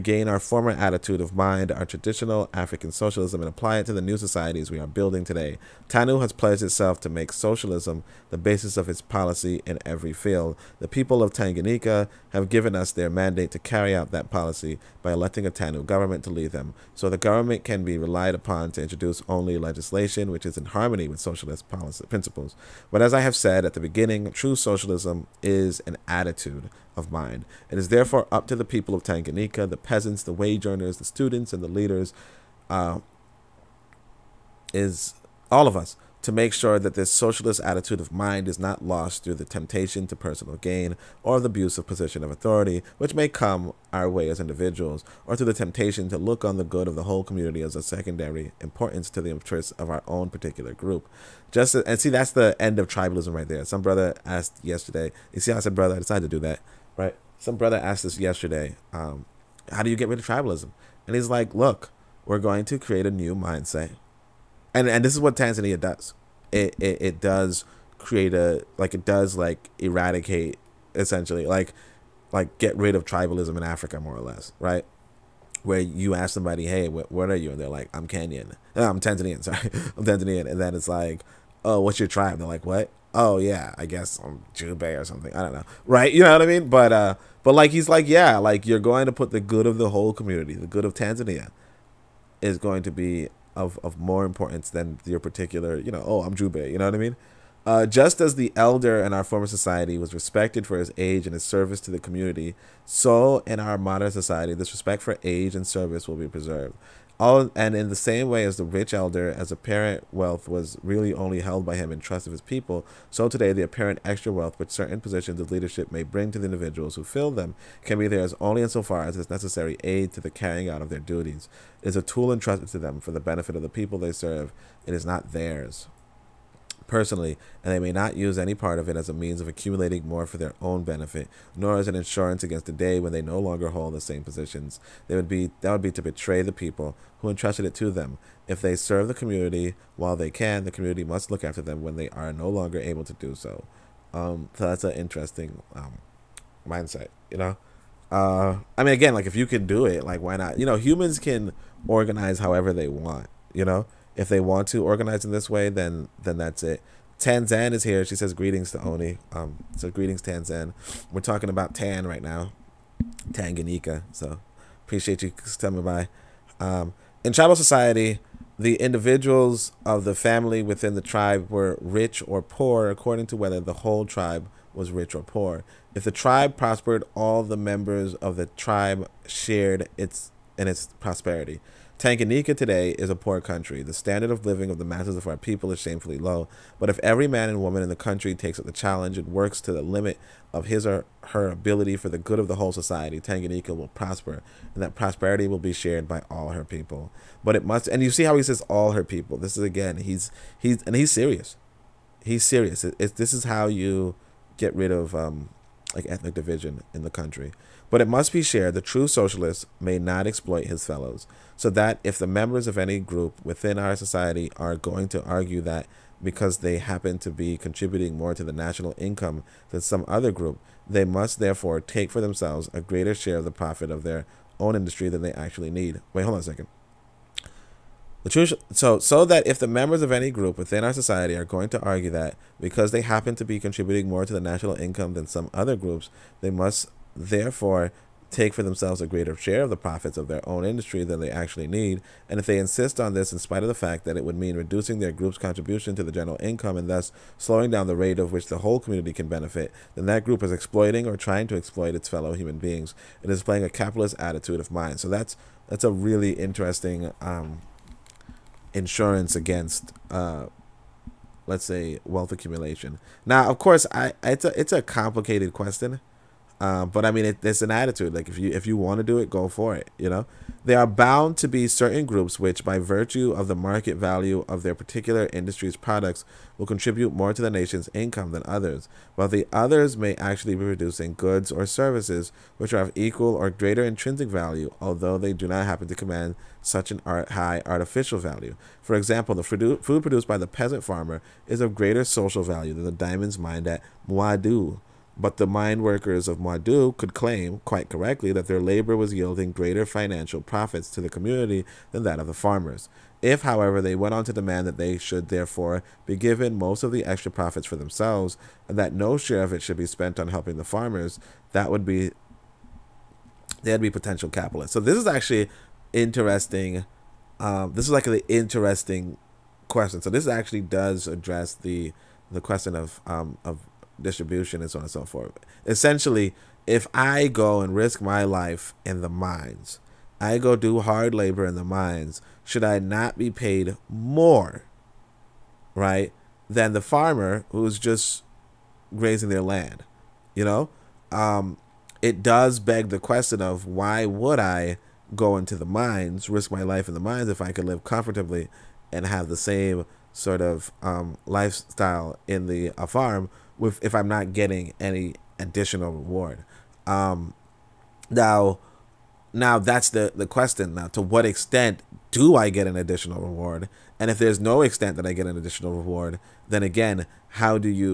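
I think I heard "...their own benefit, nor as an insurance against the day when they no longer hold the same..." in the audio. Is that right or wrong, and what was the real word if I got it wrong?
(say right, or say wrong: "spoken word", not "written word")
right.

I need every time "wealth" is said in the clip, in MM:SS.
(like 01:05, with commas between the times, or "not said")
01:50, 01:54, 04:22.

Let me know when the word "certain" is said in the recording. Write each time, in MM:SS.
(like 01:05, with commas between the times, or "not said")
01:54, 04:31.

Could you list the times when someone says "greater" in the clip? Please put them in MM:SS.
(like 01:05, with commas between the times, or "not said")
03:42, 03:59, 04:43, 04:51, 04:59.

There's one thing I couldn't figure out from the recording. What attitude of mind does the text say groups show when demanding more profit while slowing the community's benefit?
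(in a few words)
capitalist.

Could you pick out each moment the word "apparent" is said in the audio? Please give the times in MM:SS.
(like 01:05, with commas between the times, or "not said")
01:49, 01:53.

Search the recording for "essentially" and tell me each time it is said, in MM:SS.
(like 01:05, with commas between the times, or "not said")
01:10, 05:25.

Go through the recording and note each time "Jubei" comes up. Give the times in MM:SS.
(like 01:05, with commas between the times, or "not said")
01:24, 01:36.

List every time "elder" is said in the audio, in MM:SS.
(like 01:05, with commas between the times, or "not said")
01:38, 01:48.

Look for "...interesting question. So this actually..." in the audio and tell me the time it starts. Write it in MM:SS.
05:18.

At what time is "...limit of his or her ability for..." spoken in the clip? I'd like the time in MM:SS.
03:09.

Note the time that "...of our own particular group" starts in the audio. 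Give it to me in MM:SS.
00:49.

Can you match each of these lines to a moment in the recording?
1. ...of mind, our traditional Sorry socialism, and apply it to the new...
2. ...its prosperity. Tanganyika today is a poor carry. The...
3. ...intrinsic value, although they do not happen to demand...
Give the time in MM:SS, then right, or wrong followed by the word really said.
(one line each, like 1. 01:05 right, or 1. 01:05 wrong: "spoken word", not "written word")
1. 00:01 wrong: "African", not "Sorry"
2. 03:00 wrong: "country", not "carry"
3. 04:43 wrong: "command", not "demand".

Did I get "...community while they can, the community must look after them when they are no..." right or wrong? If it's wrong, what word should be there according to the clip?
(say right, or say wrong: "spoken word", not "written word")
right.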